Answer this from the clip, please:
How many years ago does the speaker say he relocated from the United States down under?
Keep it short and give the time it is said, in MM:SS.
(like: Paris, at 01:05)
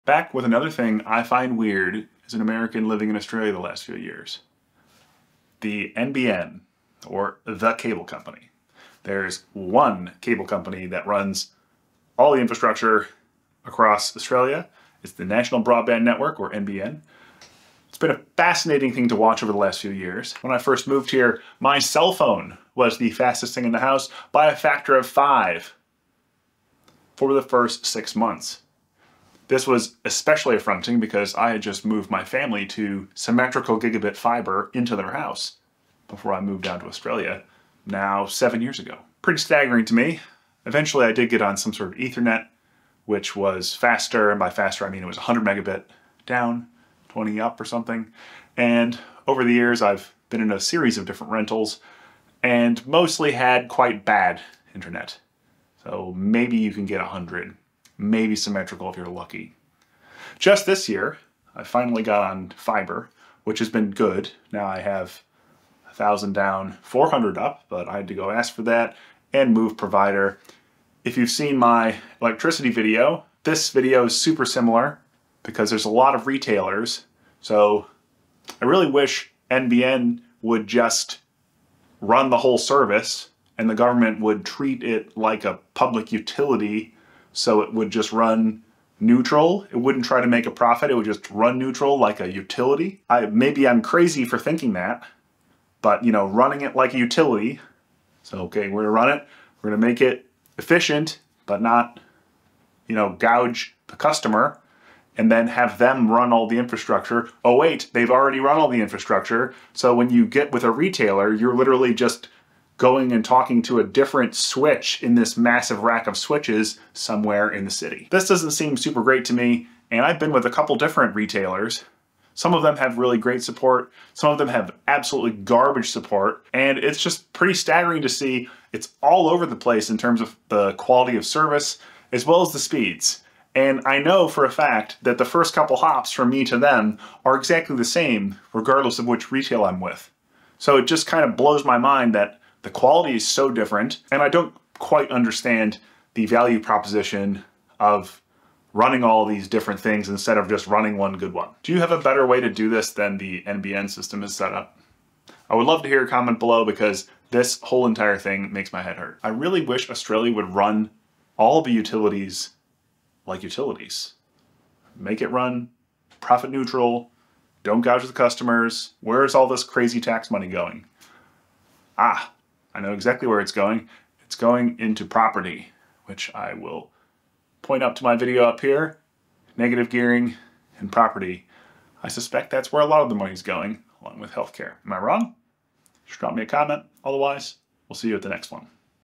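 7, at 00:38.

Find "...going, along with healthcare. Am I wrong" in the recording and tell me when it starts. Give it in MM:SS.
03:03.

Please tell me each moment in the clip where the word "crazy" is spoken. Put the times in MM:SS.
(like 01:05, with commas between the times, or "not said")
01:33, 02:49.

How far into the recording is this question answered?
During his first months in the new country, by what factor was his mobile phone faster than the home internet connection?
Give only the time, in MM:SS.
00:24.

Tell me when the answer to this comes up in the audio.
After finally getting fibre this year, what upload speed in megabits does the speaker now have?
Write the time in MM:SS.
01:06.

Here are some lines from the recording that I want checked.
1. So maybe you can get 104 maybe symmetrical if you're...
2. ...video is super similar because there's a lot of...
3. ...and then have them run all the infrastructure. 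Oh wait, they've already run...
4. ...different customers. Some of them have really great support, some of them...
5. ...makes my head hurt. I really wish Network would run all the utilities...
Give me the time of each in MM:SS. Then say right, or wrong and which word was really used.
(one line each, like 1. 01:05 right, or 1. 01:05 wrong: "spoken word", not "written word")
1. 00:55 wrong: "100", not "104"
2. 01:13 right
3. 01:45 right
4. 02:00 wrong: "retailers", not "customers"
5. 02:38 wrong: "Australia", not "Network".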